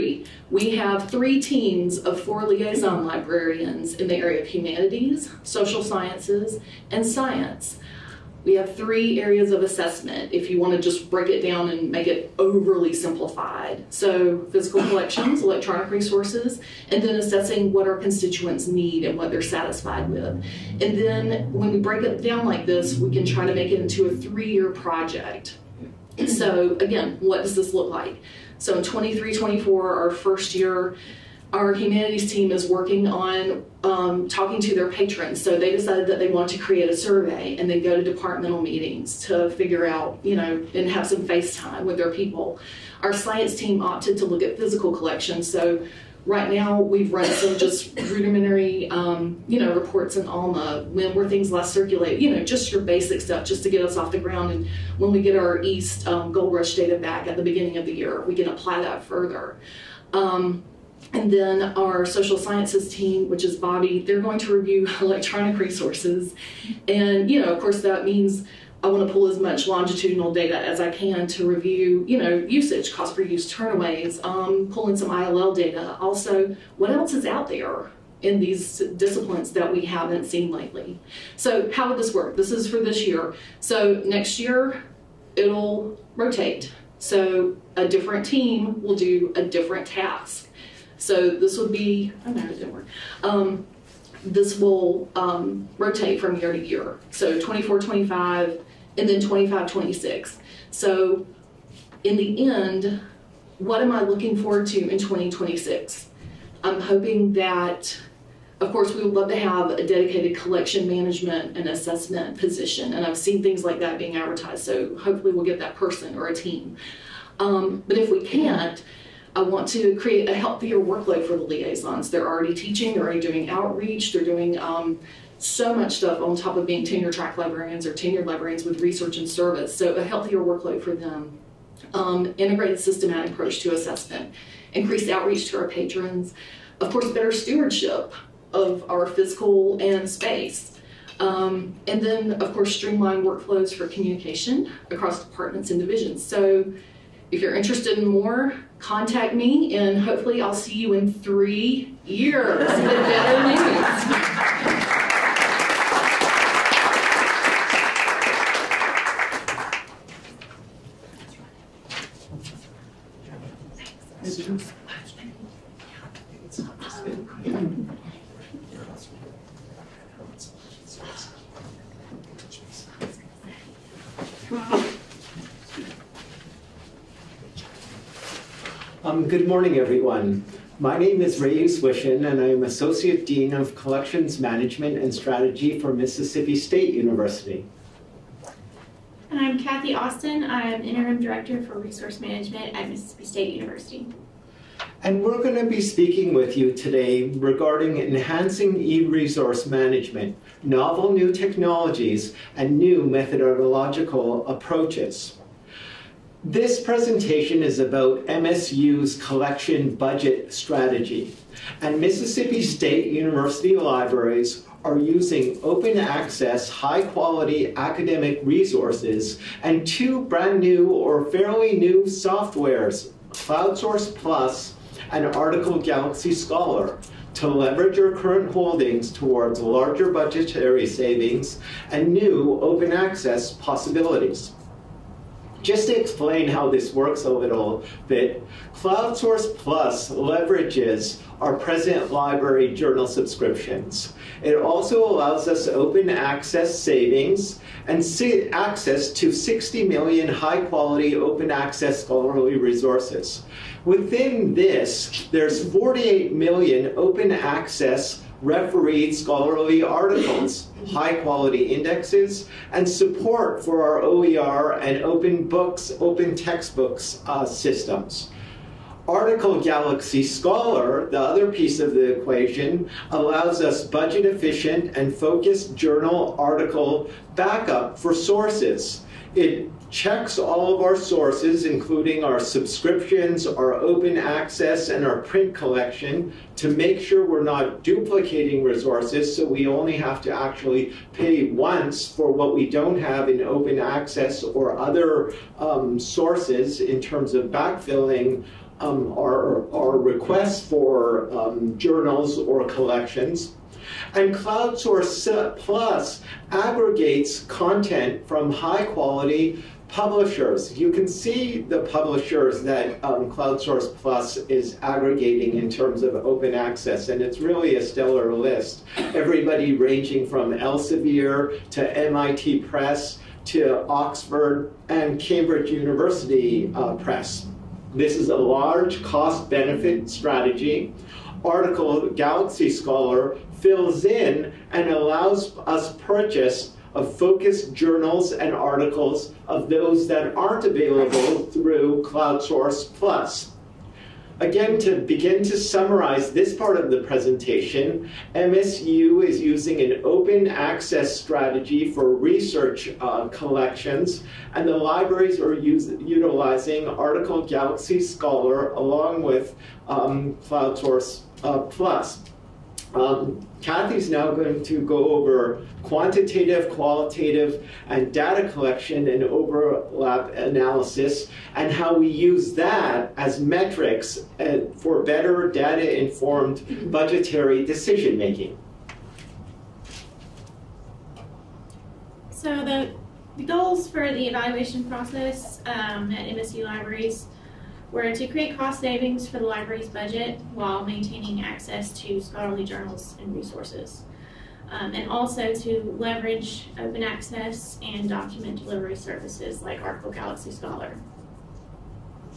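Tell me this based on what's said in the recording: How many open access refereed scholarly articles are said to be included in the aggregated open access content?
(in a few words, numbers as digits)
48 million.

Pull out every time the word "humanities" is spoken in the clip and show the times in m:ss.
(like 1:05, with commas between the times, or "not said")
0:04, 0:31.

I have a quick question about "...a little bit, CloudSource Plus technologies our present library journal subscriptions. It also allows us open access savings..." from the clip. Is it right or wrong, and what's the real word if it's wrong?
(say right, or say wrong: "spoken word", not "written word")
wrong: "leverages", not "technologies".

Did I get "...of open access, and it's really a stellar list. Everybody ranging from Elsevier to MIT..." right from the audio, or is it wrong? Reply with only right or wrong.
right.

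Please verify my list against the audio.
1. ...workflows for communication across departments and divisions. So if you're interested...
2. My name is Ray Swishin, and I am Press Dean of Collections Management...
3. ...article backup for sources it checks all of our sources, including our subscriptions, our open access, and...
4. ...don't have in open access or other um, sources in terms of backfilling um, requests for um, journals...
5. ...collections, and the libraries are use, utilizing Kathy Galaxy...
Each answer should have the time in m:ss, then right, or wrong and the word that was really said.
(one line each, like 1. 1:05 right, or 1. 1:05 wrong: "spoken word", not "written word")
1. 2:23 right
2. 3:00 wrong: "Associate", not "Press"
3. 4:36 right
4. 4:52 right
5. 5:53 wrong: "Article", not "Kathy".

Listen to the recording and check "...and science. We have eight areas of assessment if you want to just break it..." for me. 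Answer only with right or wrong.
wrong.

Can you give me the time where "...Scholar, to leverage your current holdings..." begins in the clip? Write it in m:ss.
3:46.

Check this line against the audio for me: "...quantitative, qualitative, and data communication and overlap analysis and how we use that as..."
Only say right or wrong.
wrong.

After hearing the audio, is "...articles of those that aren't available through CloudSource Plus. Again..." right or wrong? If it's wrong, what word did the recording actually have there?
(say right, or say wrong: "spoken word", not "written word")
right.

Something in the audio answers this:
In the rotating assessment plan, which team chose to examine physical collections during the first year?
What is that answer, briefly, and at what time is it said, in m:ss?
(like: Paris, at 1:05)
science team, at 0:43.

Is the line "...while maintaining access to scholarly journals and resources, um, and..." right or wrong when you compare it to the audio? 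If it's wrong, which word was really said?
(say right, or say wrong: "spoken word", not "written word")
right.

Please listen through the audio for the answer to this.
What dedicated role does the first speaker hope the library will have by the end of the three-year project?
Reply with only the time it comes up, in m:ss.
1:50.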